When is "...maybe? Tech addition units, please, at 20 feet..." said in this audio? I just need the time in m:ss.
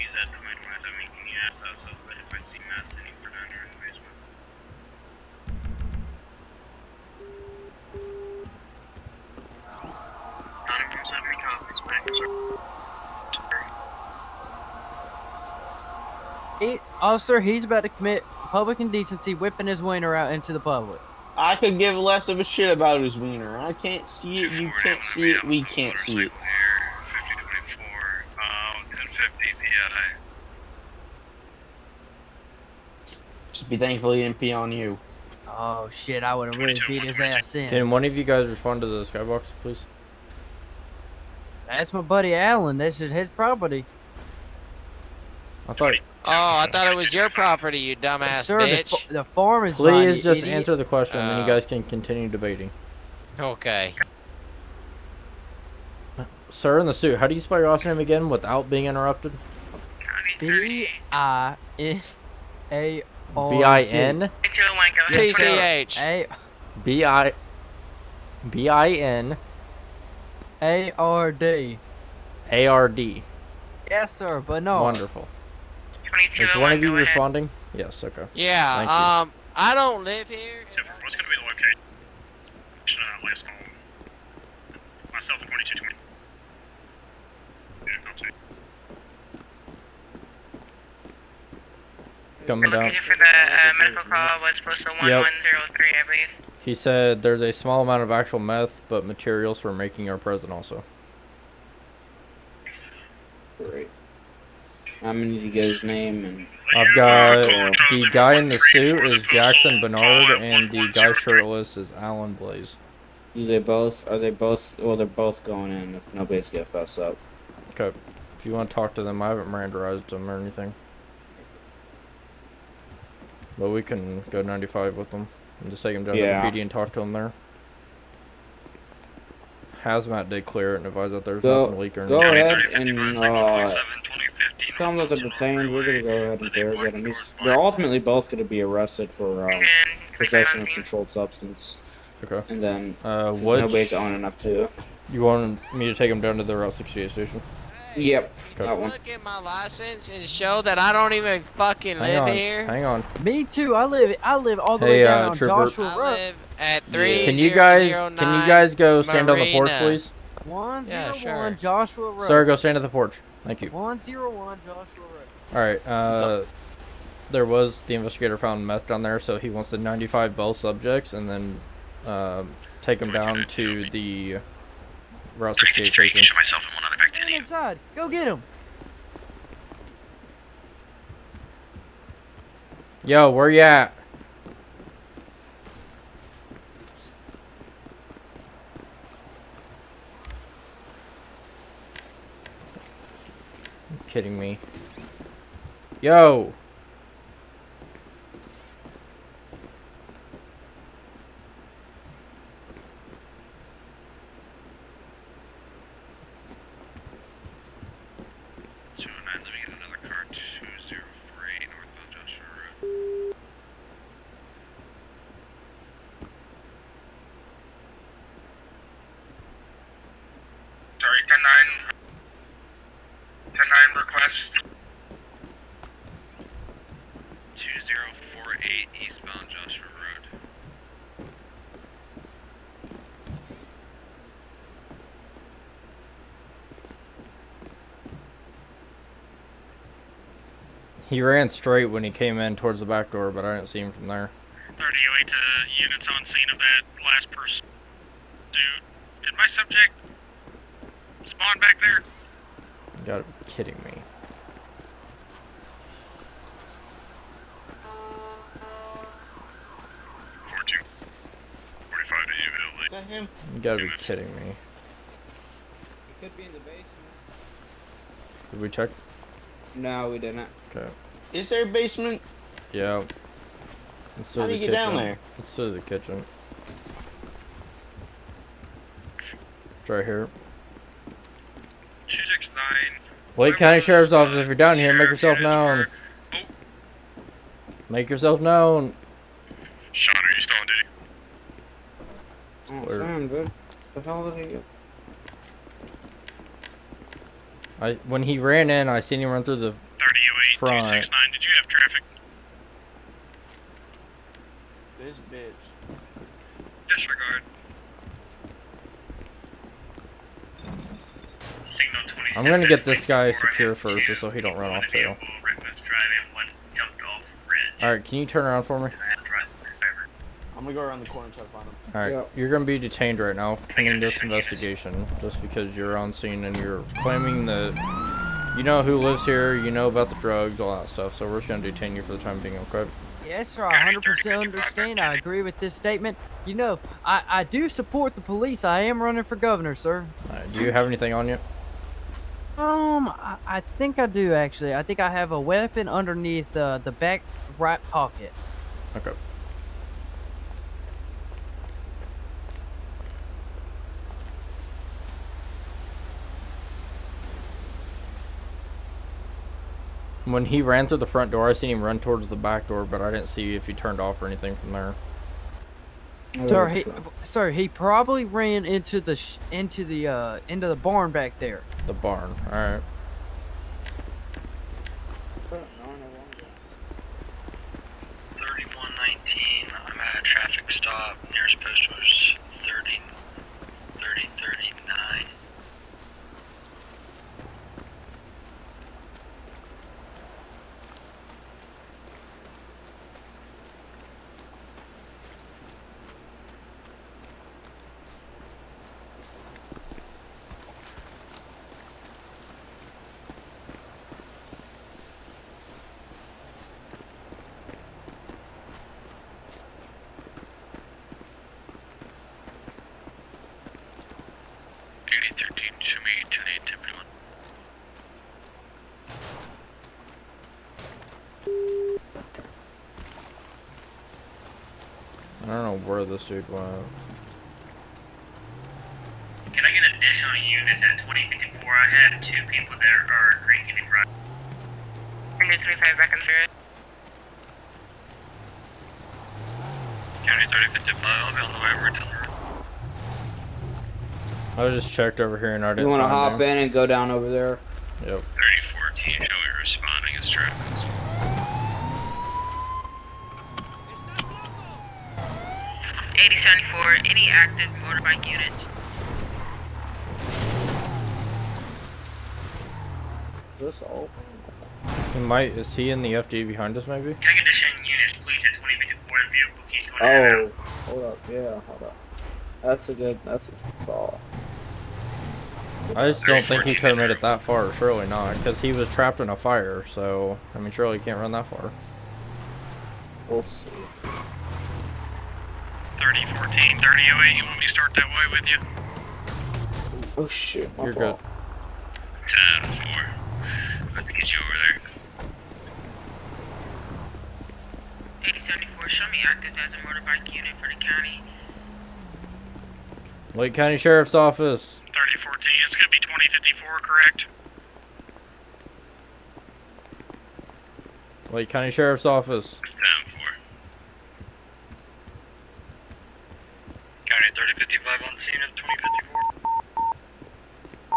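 7:46.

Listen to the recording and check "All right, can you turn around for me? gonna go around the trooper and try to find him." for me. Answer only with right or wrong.
wrong.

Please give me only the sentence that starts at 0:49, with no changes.
The, the farm is Please mine, just idiot.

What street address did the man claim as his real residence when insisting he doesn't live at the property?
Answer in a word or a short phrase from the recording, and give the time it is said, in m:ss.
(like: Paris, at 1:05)
101 Joshua Road, at 2:43.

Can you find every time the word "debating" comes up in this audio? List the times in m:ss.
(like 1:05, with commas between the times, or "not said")
0:52.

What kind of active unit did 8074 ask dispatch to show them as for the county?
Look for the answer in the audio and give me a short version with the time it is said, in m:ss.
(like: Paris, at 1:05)
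motorbike unit, at 8:19.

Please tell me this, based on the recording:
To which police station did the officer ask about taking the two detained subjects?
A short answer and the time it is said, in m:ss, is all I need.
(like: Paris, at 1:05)
Route 68 station, at 2:26.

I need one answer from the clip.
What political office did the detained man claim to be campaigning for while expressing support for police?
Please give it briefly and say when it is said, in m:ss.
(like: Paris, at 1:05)
governor, at 5:39.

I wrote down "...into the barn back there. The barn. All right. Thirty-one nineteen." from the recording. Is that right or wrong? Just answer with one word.
right.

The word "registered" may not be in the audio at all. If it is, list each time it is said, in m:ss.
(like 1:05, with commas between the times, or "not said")
7:06.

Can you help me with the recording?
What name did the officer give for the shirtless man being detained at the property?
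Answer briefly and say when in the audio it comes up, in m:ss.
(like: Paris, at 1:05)
Alan Blaze, at 1:51.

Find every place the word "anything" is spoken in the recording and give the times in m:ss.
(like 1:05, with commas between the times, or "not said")
2:00, 5:40, 6:04.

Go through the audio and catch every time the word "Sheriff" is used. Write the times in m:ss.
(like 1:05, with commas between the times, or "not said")
4:43, 8:23, 8:31.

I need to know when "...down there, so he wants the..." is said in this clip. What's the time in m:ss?
2:48.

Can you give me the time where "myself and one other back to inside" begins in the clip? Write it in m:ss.
2:56.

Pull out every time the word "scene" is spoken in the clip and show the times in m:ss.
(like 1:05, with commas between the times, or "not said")
4:06, 5:26, 8:38.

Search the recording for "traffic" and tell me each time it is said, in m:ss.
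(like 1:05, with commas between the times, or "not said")
5:01, 6:20.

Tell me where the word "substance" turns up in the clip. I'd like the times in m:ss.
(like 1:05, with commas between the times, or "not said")
2:21.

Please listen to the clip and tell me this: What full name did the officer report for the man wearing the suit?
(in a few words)
Jackson Bernard.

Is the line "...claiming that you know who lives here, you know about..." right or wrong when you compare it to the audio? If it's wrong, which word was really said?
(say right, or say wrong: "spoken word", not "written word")
right.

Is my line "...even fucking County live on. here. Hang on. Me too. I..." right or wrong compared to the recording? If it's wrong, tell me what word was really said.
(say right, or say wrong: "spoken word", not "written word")
wrong: "Hang", not "County".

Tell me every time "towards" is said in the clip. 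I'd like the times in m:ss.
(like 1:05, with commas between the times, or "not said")
4:02, 6:02.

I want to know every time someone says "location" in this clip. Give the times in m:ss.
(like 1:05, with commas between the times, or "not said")
1:21, 1:32.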